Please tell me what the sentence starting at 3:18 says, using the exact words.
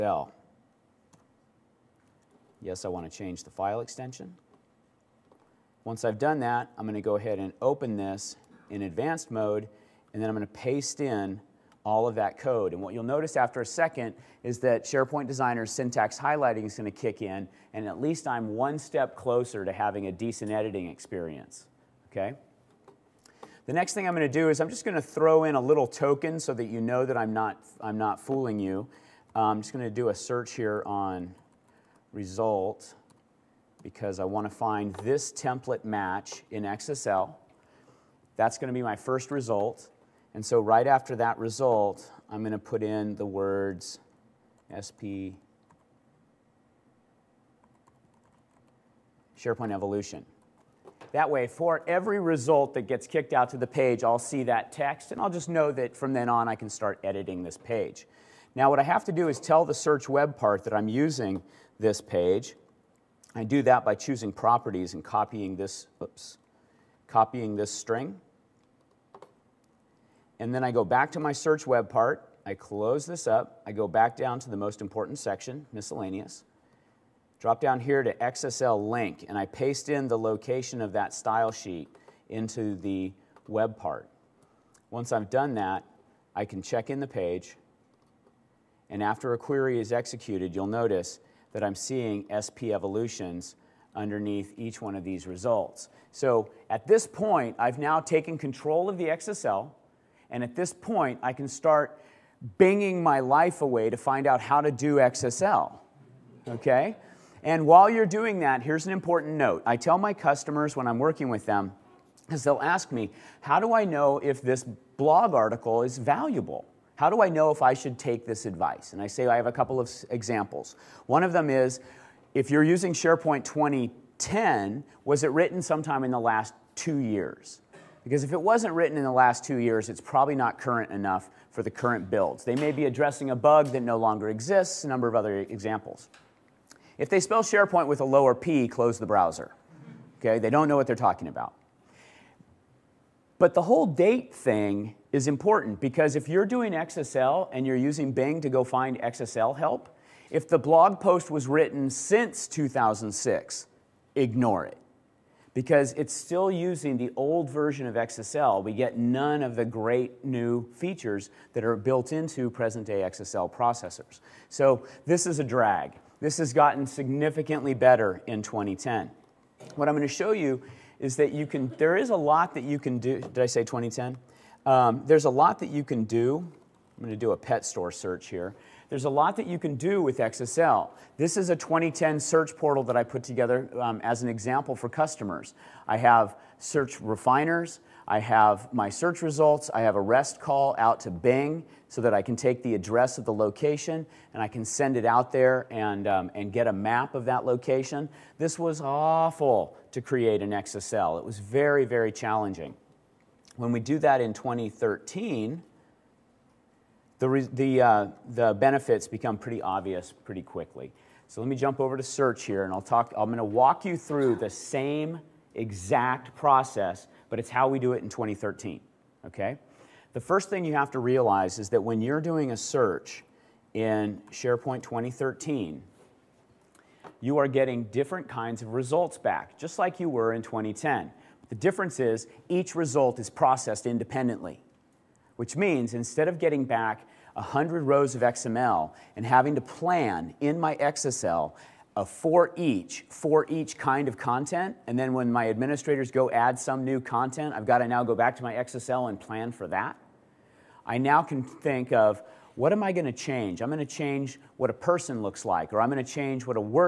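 This was awful to create in XSL.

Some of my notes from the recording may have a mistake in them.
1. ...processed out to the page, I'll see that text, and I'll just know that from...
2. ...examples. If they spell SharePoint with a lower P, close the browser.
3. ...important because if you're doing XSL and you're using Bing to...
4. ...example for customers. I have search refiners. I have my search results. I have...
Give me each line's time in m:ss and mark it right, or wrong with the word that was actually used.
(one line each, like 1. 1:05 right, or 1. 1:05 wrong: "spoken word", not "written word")
1. 0:53 wrong: "kicked", not "processed"
2. 2:15 right
3. 2:25 right
4. 3:04 right.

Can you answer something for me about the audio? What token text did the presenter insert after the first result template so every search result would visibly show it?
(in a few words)
SP SharePoint Evolution.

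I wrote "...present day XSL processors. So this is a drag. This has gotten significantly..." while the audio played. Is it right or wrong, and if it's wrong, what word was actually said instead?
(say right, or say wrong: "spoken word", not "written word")
right.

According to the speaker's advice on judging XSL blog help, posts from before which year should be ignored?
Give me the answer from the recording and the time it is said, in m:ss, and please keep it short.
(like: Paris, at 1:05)
2006, at 2:32.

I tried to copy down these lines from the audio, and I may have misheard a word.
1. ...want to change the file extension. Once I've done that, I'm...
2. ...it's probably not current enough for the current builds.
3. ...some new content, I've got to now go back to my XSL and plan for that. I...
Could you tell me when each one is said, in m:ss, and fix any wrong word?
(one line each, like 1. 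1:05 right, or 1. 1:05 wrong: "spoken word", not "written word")
1. 0:02 right
2. 2:09 right
3. 4:06 right.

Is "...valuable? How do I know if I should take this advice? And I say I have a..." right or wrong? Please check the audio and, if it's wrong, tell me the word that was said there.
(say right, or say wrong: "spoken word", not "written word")
right.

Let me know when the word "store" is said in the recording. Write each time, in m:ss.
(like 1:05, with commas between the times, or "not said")
2:57.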